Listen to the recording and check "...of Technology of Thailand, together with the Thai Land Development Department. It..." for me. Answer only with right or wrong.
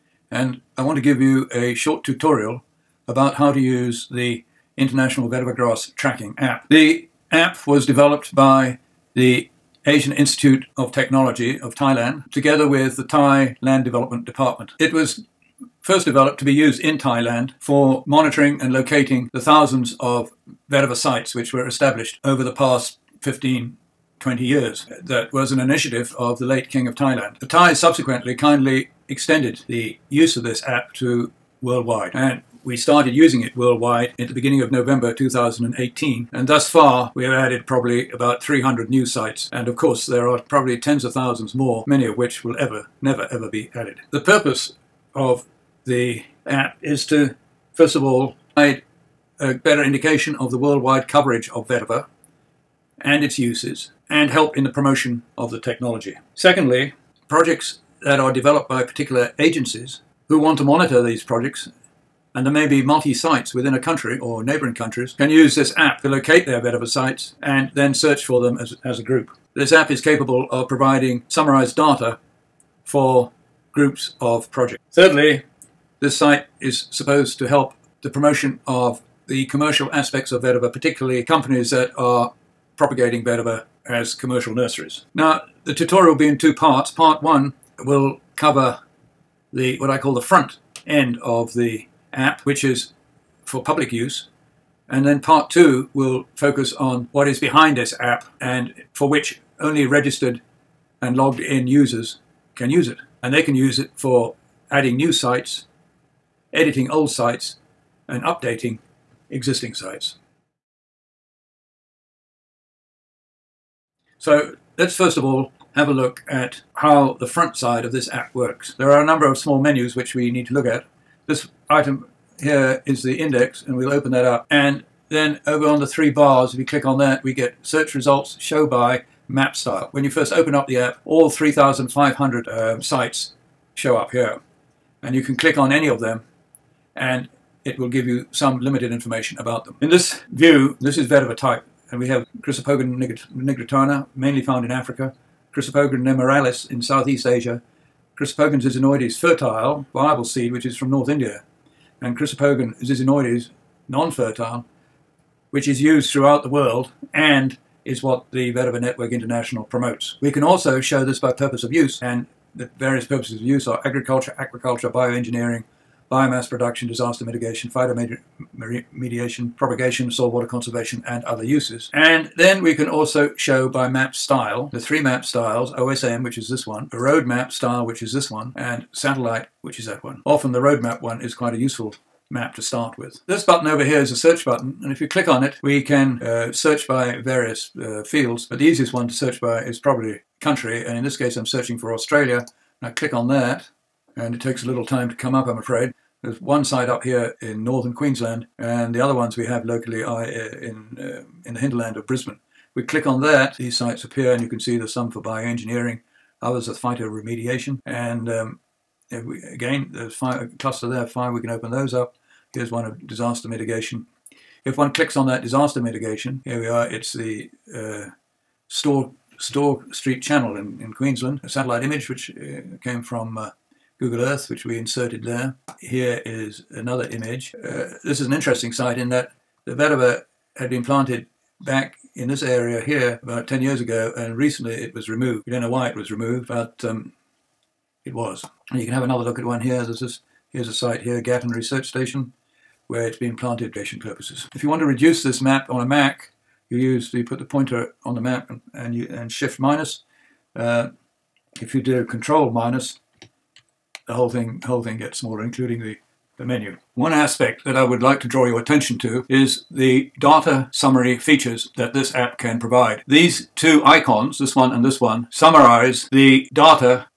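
right.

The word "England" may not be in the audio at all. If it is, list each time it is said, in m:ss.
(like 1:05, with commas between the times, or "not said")
not said.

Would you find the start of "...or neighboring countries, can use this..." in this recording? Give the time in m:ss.
1:04.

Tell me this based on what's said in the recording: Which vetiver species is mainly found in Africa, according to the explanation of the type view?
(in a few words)
Chrysopogon nigritana.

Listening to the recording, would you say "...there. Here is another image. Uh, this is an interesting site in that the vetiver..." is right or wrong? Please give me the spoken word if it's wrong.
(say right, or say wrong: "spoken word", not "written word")
right.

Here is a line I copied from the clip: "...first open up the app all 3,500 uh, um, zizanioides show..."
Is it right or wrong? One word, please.
wrong.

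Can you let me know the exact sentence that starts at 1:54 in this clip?
So let's first of all have a look at how the front side of this app works.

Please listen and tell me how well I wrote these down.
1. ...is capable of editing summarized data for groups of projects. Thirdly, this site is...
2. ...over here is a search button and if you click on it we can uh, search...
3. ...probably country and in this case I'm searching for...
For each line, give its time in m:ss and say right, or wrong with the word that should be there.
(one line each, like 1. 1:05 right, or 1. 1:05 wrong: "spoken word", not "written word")
1. 1:09 wrong: "providing", not "editing"
2. 3:03 right
3. 3:09 right.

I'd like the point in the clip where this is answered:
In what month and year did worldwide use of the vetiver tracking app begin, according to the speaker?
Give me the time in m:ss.
0:34.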